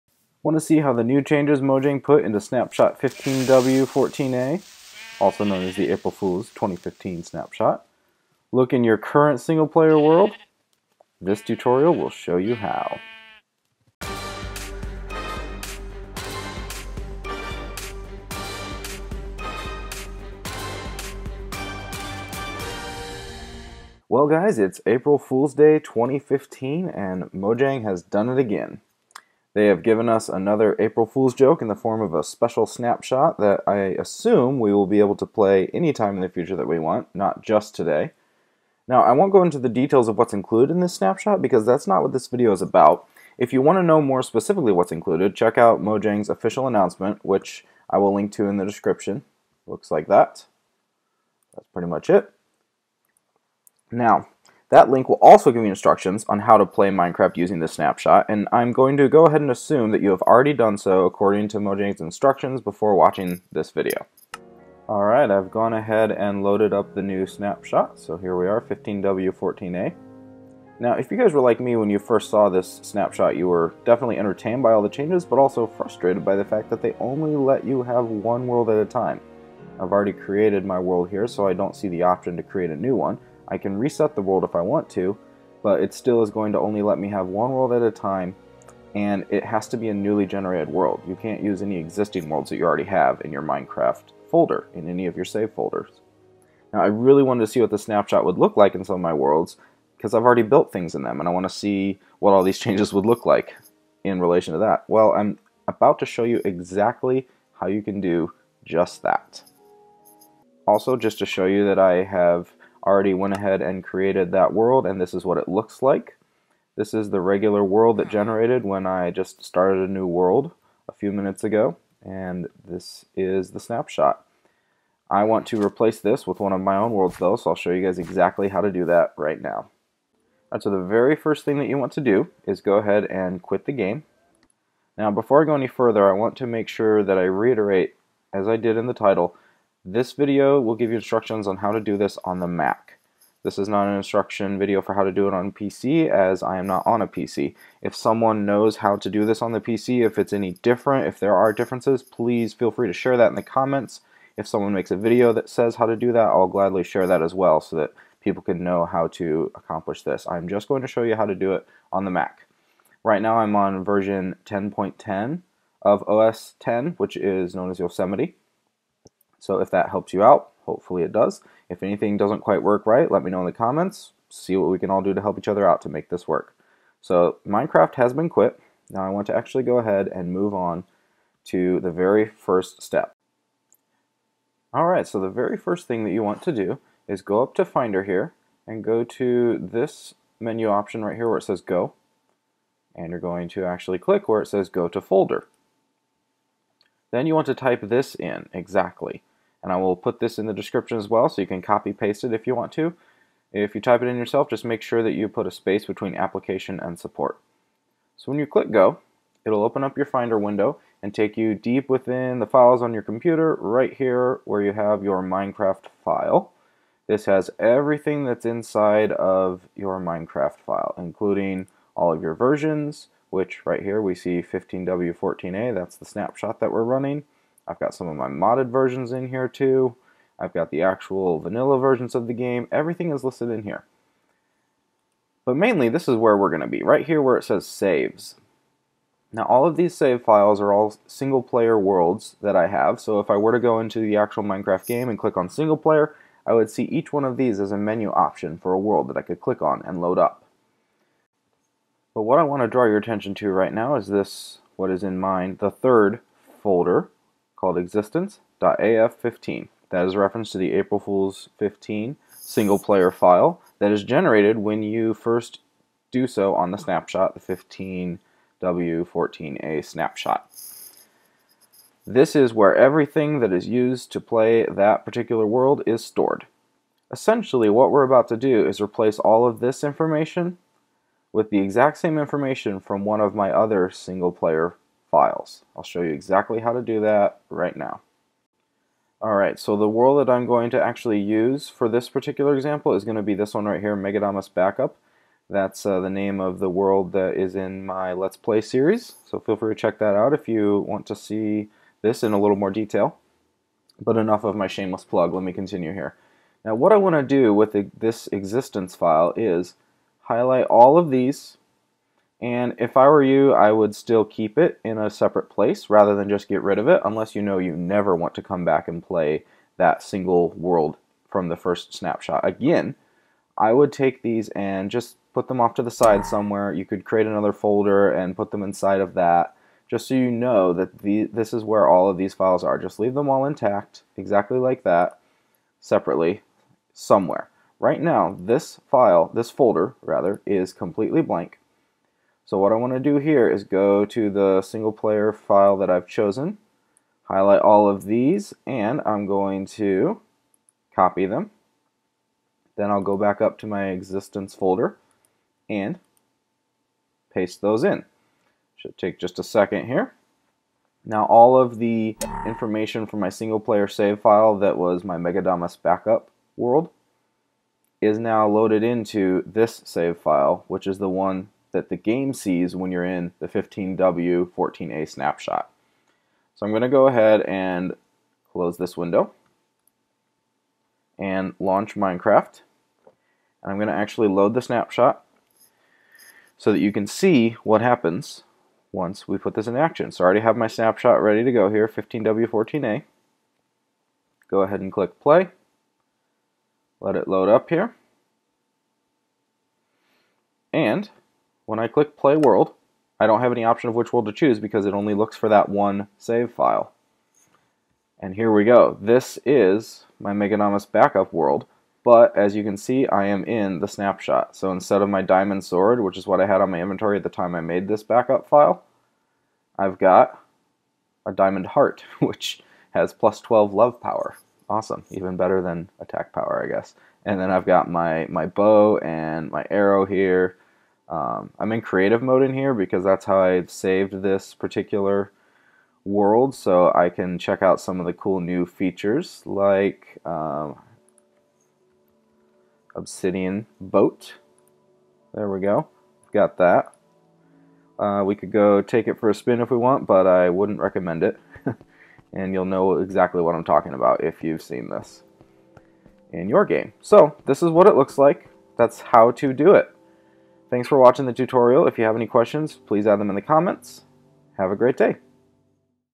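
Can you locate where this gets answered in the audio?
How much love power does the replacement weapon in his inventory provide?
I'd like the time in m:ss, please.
7:03.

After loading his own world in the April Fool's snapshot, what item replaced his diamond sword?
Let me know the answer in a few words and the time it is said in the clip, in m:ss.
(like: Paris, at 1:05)
diamond heart, at 7:01.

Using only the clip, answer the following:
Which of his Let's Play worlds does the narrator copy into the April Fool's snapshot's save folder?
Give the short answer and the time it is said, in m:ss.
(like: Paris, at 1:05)
Megadamus Backup, at 4:53.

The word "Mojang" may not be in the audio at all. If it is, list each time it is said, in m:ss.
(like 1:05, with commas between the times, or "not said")
0:01, 0:27, 0:45, 1:01.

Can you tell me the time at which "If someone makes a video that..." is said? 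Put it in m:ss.
2:34.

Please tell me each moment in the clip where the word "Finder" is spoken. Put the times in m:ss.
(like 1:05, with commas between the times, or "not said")
3:07, 3:30.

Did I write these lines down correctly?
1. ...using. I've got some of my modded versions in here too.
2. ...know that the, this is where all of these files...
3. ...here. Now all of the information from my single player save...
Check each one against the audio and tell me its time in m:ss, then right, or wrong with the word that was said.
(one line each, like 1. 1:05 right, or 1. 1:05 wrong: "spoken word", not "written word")
1. 3:46 wrong: "running", not "using"
2. 5:30 right
3. 5:59 right.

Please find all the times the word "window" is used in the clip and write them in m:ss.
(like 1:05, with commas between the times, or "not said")
3:30, 6:18.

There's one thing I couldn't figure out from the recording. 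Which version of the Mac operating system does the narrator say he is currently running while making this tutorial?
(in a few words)
Yosemite.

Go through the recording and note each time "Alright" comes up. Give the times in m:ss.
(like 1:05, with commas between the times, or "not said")
1:04, 3:04, 4:49.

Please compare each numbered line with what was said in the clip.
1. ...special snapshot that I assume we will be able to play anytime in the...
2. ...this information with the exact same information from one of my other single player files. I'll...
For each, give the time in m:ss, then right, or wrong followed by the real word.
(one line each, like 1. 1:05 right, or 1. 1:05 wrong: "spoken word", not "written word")
1. 0:32 right
2. 4:39 right.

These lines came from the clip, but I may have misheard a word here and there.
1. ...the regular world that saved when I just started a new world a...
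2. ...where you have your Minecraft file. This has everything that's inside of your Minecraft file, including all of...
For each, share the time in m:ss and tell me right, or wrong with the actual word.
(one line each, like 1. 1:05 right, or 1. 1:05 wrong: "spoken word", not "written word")
1. 1:57 wrong: "generated", not "saved"
2. 3:34 right.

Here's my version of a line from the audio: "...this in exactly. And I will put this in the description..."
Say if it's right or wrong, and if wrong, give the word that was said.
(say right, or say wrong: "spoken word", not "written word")
right.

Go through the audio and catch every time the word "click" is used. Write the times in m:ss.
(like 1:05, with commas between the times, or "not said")
3:13, 3:28, 4:05, 4:09, 6:34, 6:41.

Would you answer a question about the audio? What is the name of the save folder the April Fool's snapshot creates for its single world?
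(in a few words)
existence.af15.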